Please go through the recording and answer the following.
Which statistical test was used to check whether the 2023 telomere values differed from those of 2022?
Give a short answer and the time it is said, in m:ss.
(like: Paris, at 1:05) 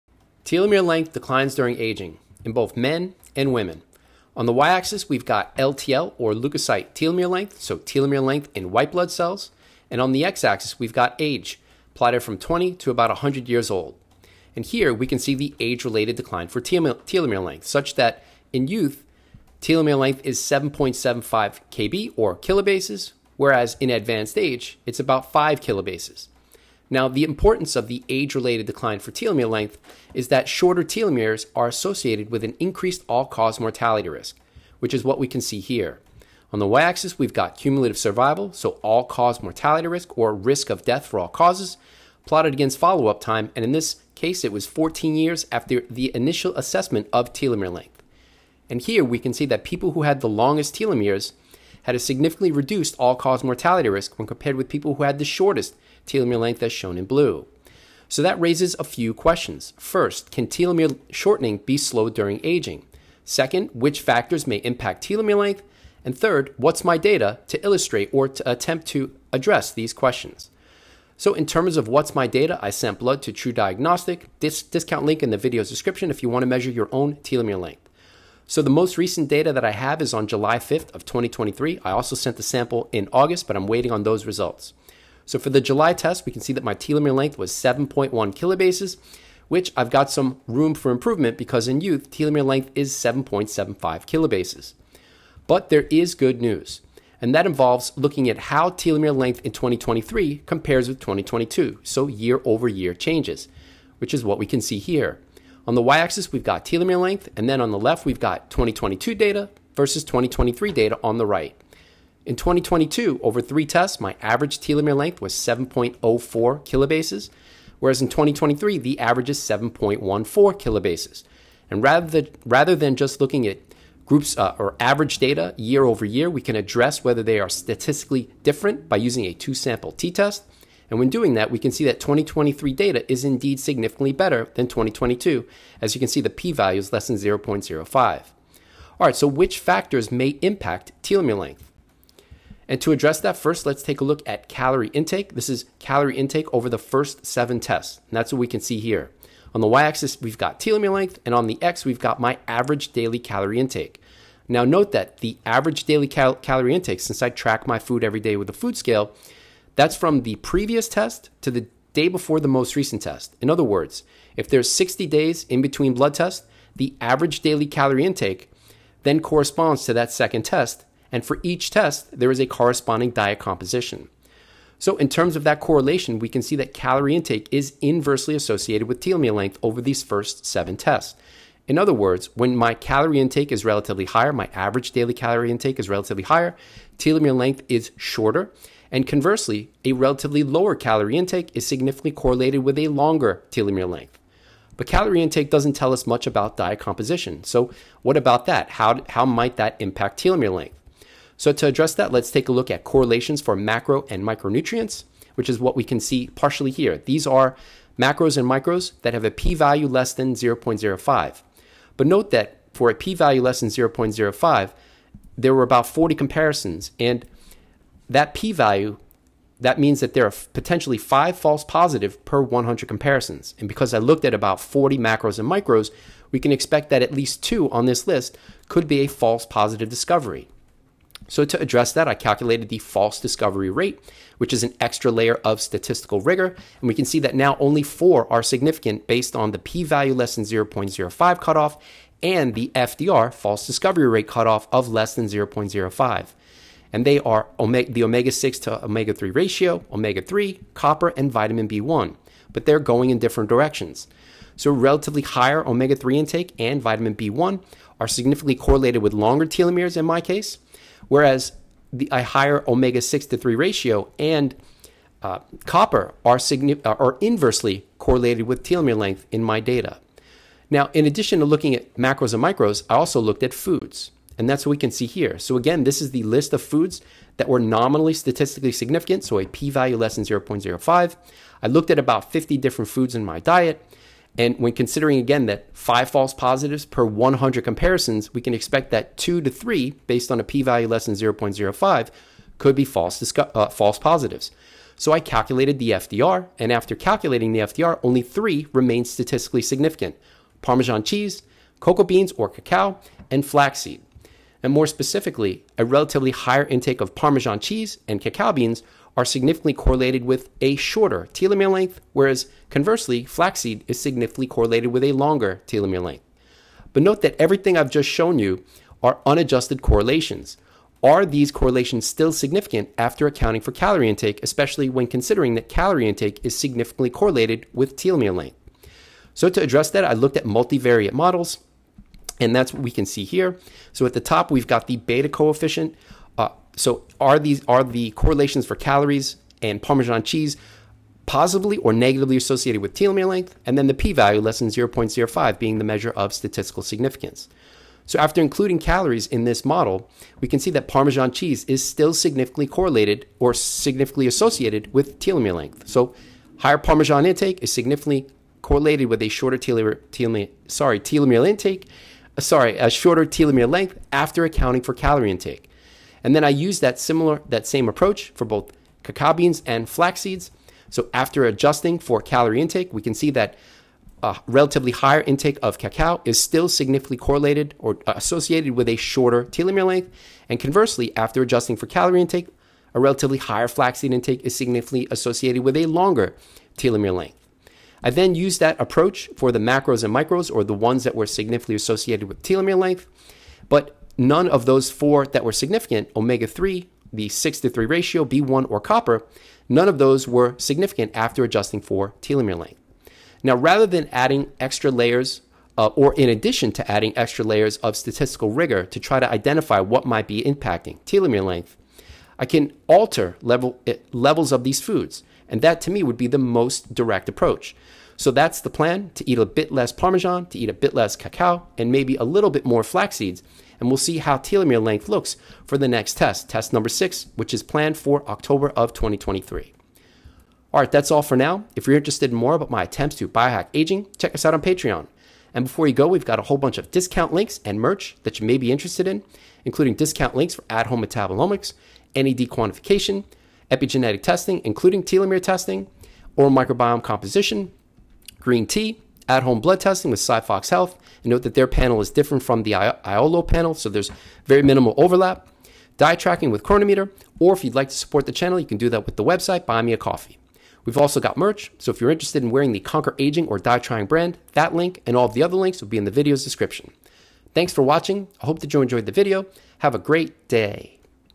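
two sample t test, at 2:09.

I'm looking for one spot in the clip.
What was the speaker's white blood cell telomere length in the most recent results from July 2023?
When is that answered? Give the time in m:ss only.
1:27.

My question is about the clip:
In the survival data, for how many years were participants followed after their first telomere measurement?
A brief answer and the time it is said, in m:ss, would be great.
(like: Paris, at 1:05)
14 years, at 0:44.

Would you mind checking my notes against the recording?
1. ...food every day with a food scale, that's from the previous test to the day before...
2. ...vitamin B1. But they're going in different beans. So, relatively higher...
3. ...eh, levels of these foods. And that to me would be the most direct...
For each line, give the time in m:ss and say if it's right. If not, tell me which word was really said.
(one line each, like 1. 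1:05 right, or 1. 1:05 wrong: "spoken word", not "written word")
1. 2:37 right
2. 4:11 wrong: "directions", not "beans"
3. 6:53 right.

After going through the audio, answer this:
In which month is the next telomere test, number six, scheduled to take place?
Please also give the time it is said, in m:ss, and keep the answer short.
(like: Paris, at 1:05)
October 2023, at 7:08.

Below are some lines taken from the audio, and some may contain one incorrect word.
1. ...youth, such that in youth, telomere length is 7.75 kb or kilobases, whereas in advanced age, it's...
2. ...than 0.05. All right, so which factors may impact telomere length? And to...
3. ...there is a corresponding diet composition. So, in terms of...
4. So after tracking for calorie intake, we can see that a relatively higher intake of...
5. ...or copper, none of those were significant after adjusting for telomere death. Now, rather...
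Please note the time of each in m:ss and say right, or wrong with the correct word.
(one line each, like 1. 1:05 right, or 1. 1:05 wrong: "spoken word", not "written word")
1. 0:17 wrong: "length", not "youth"
2. 2:17 right
3. 2:52 right
4. 6:10 wrong: "adjusting", not "tracking"
5. 6:38 wrong: "length", not "death".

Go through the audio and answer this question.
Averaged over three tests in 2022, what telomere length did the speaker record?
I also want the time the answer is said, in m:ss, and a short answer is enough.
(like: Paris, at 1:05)
7.04 kilobases, at 1:55.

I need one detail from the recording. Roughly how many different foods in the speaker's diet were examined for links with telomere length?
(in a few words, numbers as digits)
50.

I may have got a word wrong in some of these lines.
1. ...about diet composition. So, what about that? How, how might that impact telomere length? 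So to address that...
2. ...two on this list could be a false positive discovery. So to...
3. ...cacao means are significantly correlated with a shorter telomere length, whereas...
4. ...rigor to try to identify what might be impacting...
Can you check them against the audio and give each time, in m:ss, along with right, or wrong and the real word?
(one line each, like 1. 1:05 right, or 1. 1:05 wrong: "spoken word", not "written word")
1. 3:16 right
2. 3:47 right
3. 5:08 wrong: "beans", not "means"
4. 6:48 right.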